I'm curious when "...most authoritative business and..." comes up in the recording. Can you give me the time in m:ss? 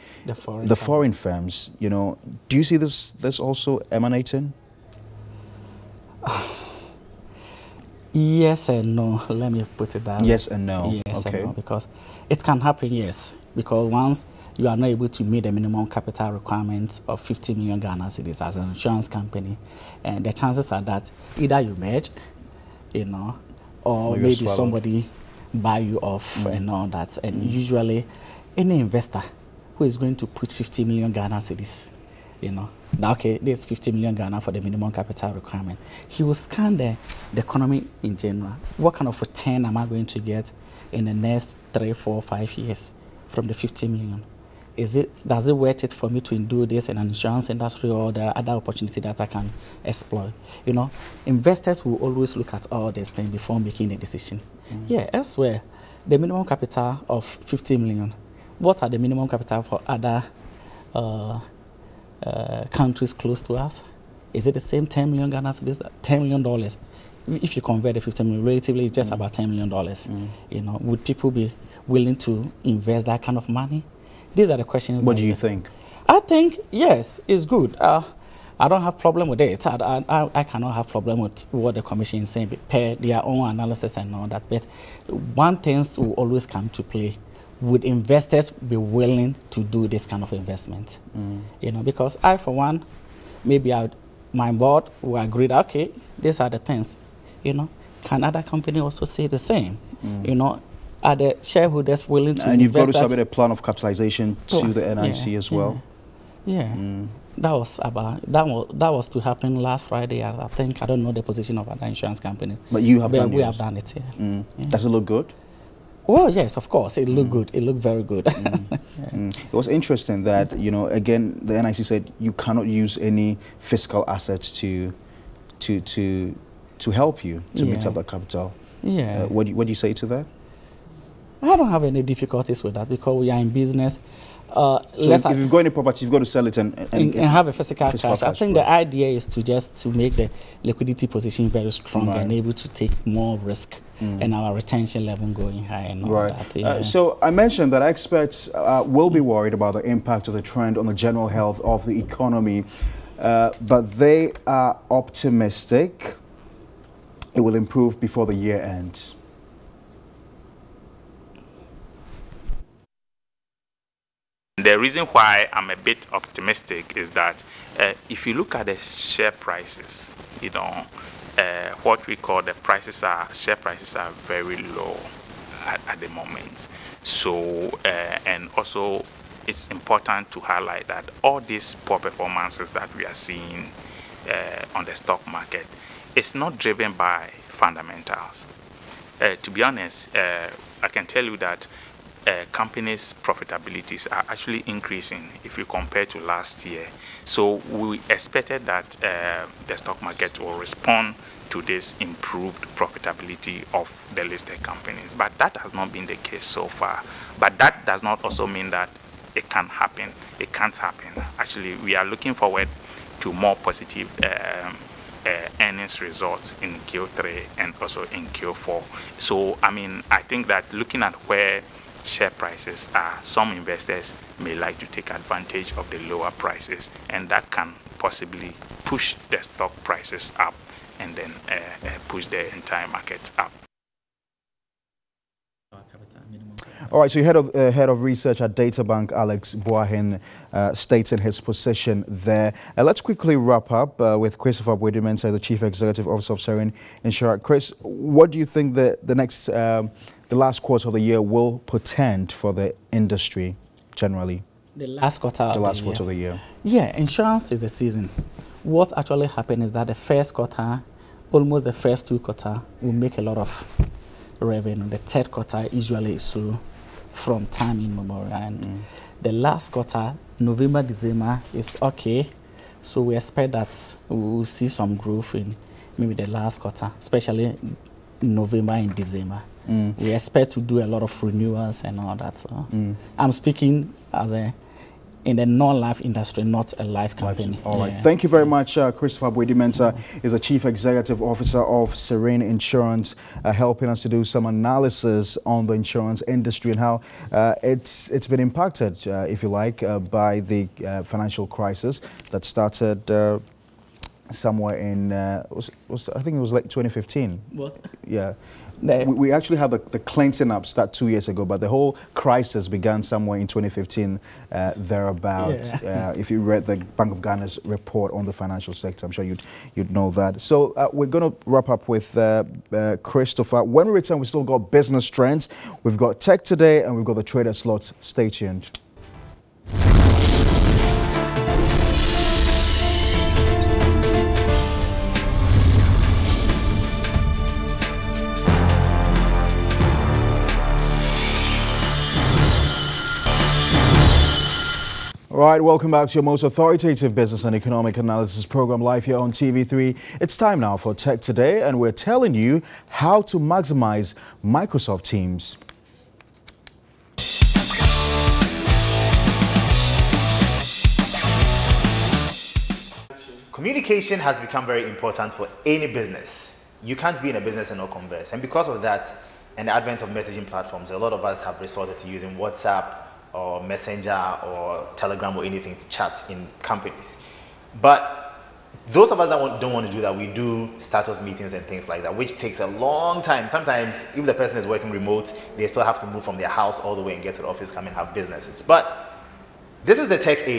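5:46.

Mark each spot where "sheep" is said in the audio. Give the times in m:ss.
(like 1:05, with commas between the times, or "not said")
not said.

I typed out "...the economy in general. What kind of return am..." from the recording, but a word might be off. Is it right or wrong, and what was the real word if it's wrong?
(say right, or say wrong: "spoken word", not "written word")
right.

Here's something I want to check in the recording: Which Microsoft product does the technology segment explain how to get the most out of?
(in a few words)
Microsoft Teams.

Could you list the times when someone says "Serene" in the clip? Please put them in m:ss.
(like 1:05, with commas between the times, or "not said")
4:06, 4:51.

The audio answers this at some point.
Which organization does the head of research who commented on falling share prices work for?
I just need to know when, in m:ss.
3:58.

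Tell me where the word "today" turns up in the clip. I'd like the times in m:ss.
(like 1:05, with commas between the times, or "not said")
5:26, 5:51.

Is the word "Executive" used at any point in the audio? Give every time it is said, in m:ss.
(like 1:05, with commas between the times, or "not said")
4:05, 4:50.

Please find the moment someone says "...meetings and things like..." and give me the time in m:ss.
6:21.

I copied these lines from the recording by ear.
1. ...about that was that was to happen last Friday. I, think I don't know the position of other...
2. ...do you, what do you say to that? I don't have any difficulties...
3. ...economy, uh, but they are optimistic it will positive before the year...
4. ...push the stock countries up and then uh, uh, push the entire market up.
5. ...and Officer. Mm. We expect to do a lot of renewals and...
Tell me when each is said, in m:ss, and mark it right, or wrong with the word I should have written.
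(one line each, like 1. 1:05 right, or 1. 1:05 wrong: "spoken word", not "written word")
1. 1:47 right
2. 2:09 right
3. 2:31 wrong: "improve", not "positive"
4. 3:48 wrong: "prices", not "countries"
5. 4:38 wrong: "December", not "Officer".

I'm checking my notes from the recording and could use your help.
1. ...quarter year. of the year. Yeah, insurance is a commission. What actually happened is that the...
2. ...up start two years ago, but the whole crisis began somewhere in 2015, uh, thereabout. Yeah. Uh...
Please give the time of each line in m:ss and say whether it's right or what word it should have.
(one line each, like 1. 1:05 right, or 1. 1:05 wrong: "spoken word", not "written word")
1. 4:15 wrong: "season", not "commission"
2. 5:10 right.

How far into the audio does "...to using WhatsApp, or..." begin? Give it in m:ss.
6:12.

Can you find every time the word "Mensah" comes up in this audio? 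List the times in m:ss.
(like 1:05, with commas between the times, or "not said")
4:05, 4:49.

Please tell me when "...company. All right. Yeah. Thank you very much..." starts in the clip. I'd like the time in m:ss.
4:47.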